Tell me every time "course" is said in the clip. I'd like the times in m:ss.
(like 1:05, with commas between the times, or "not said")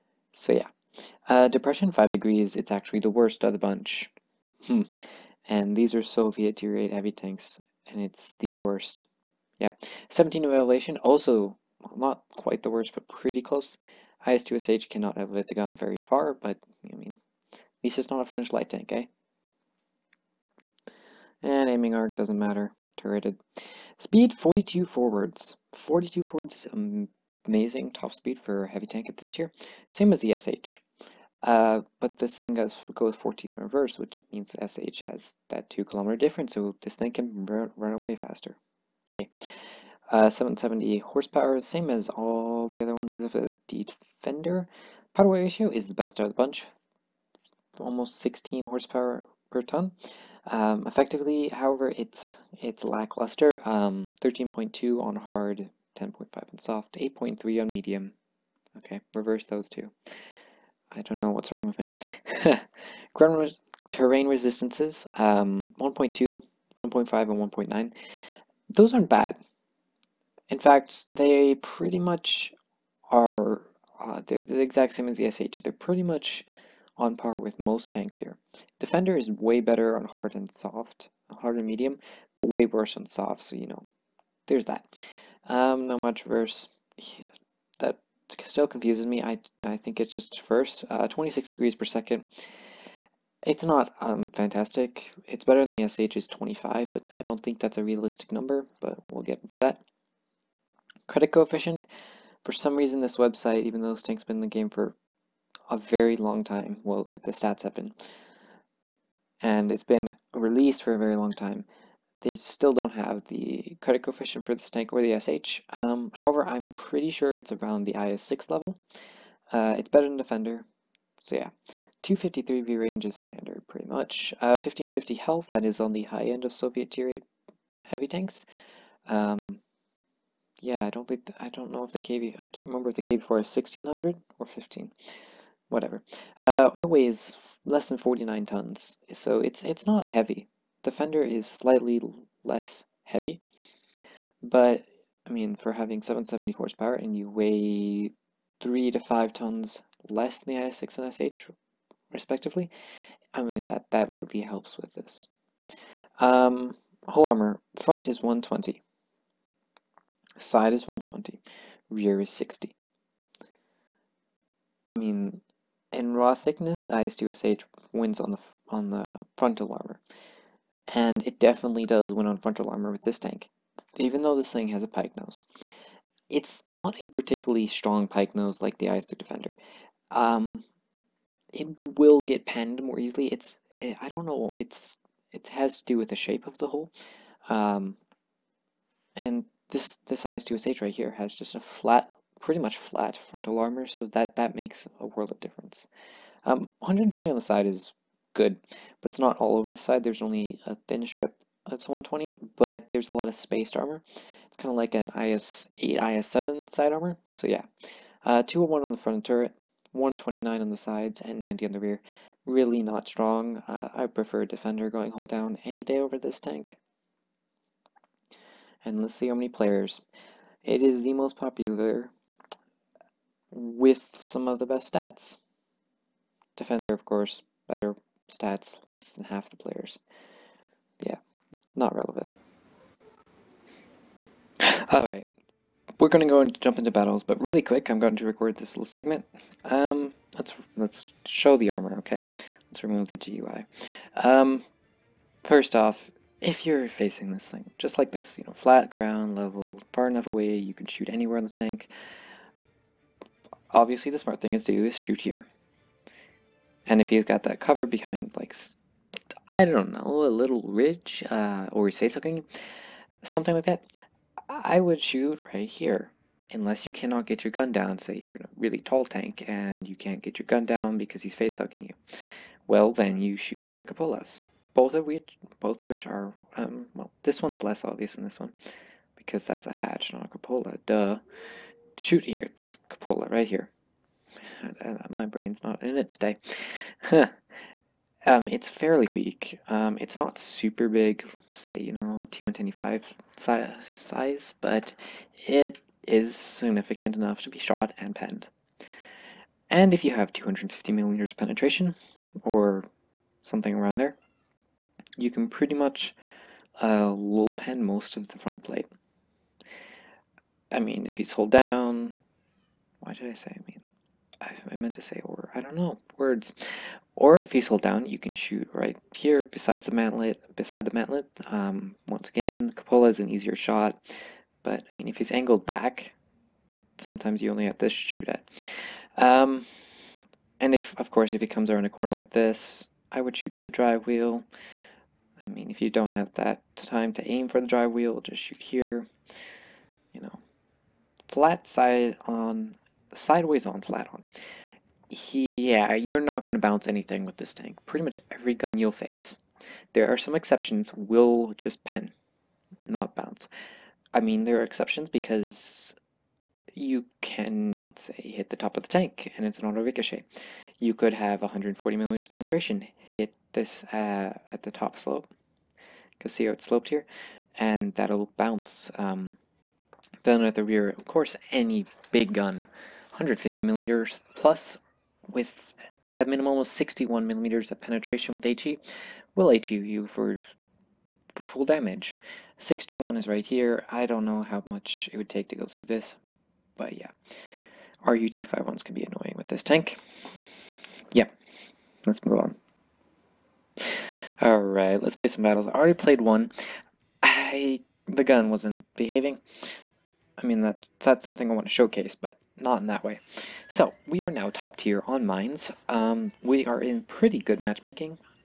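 3:47, 5:31, 6:11.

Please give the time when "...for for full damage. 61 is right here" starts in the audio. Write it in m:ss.
6:20.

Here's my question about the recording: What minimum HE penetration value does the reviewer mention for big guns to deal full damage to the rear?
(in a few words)
61 millimeters.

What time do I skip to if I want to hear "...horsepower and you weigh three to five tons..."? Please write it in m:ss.
2:26.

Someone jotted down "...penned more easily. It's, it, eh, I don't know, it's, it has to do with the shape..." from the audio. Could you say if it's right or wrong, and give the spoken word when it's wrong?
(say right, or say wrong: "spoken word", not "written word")
right.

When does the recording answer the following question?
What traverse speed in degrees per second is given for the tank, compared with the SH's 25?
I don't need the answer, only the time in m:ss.
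1:31.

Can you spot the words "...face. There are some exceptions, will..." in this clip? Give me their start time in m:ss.
5:48.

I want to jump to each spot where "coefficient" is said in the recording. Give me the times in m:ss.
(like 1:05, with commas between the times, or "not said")
1:41, 1:54.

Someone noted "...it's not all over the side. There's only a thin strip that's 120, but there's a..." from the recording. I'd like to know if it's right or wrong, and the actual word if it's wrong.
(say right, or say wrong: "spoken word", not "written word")
right.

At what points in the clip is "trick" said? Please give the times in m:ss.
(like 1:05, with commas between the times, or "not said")
not said.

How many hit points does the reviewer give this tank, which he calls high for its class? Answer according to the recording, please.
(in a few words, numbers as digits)
1550.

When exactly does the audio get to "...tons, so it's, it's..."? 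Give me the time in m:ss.
2:18.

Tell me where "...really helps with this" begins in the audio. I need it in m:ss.
2:34.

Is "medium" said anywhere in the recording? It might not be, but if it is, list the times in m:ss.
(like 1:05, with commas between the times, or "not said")
0:57, 1:21.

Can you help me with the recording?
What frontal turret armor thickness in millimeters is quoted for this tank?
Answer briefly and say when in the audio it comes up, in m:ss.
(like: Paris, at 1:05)
201, at 3:28.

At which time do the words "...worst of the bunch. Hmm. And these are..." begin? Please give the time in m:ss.
0:03.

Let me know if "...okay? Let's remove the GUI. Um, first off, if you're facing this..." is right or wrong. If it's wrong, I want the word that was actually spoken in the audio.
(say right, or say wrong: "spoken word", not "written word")
right.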